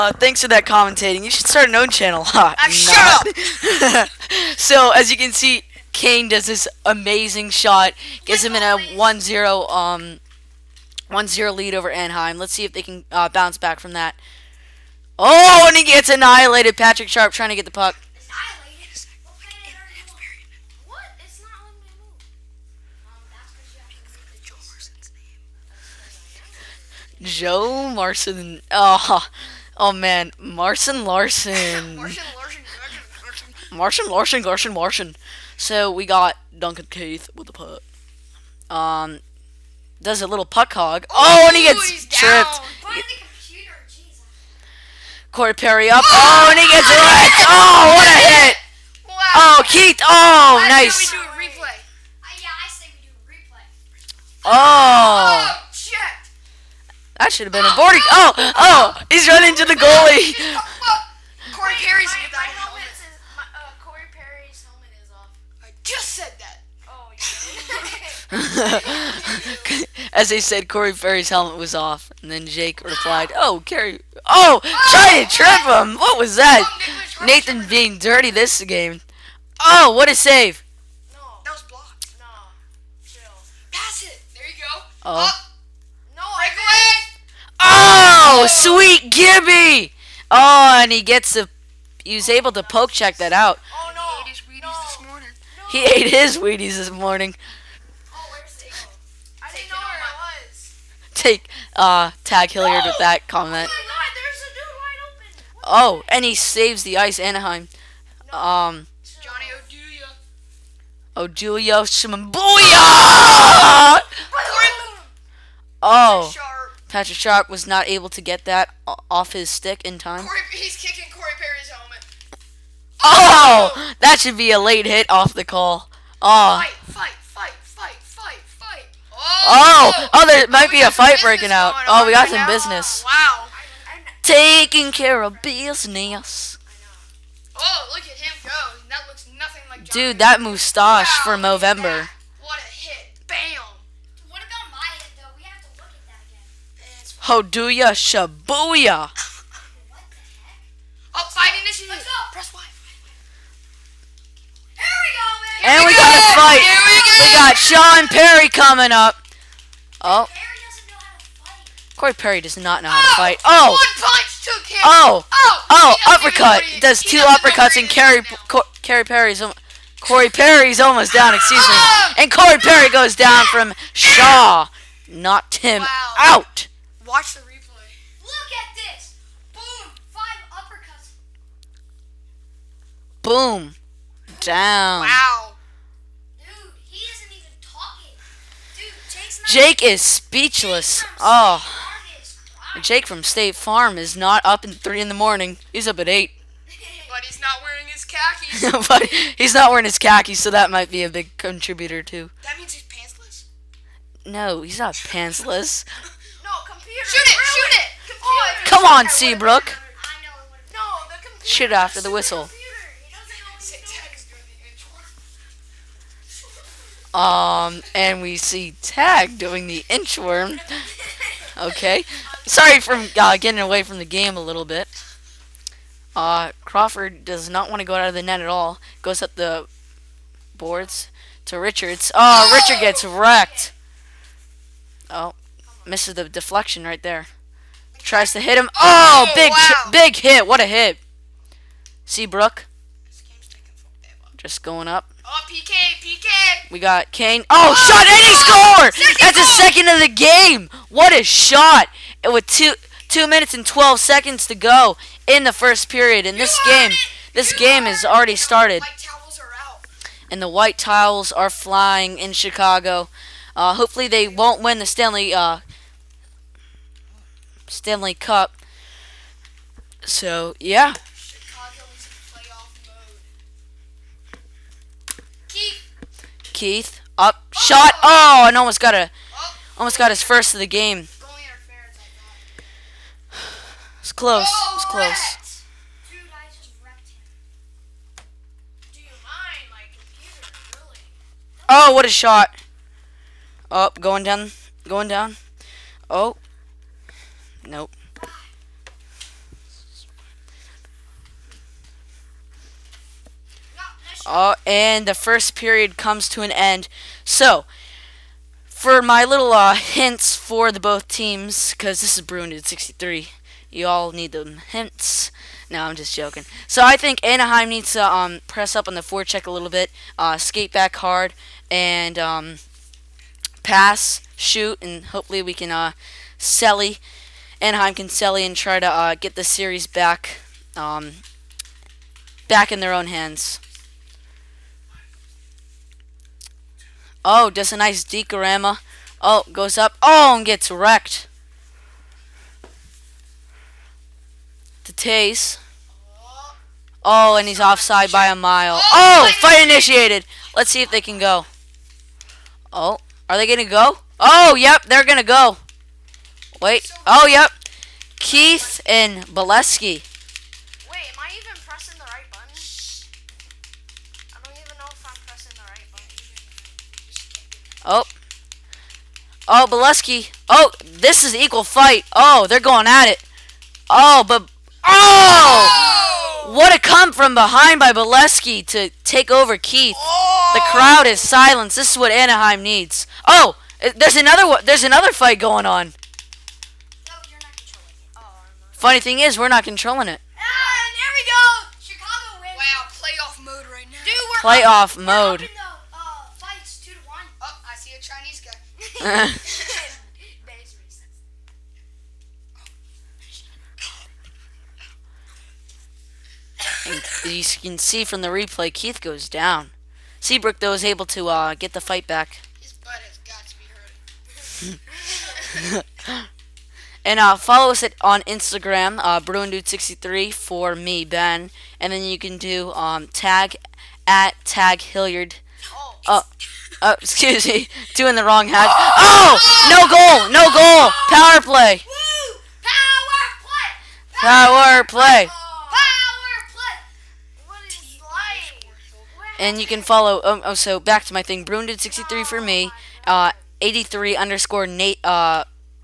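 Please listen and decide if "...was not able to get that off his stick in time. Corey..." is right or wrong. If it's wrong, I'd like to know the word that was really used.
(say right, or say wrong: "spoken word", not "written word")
right.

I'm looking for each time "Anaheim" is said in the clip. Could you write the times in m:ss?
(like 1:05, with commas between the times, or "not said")
0:11, 1:47, 5:17, 5:27, 6:22.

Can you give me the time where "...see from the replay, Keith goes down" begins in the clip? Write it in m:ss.
6:47.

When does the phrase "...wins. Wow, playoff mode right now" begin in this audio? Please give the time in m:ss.
6:32.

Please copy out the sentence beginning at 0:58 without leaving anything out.
Oh, oh, he's running to the goalie.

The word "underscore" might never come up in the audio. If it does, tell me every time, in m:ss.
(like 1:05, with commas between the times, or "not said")
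7:24.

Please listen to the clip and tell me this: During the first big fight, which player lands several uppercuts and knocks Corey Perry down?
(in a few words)
Shaw.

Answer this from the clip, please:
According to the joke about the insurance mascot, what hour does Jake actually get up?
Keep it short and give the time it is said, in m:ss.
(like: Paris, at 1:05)
8, at 3:16.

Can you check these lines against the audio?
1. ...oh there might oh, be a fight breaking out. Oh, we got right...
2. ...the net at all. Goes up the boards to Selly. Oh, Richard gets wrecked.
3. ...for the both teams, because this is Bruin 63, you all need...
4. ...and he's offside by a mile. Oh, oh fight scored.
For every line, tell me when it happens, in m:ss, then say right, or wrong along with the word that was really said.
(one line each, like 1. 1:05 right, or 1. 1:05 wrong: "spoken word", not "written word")
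1. 2:10 right
2. 3:48 wrong: "Richards", not "Selly"
3. 5:10 right
4. 5:47 wrong: "initiated", not "scored".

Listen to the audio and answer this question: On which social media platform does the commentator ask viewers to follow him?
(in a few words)
Instagram.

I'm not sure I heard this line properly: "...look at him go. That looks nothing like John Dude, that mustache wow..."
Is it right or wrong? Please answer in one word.
right.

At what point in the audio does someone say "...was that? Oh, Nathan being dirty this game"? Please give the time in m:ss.
1:16.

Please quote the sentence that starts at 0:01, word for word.
You should start an own channel.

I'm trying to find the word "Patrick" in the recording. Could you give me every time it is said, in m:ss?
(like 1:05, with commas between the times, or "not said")
0:16, 1:56.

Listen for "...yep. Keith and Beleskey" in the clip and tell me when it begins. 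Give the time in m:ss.
5:57.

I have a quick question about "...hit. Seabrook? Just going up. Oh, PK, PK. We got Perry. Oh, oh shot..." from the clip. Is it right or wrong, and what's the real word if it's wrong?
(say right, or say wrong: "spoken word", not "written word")
wrong: "Kane", not "Perry".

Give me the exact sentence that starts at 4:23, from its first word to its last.
Uh, hopefully they won't win the Stanley uh, Stanley Cup.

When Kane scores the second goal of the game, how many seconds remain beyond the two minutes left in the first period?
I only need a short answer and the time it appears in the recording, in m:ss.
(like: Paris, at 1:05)
12, at 4:13.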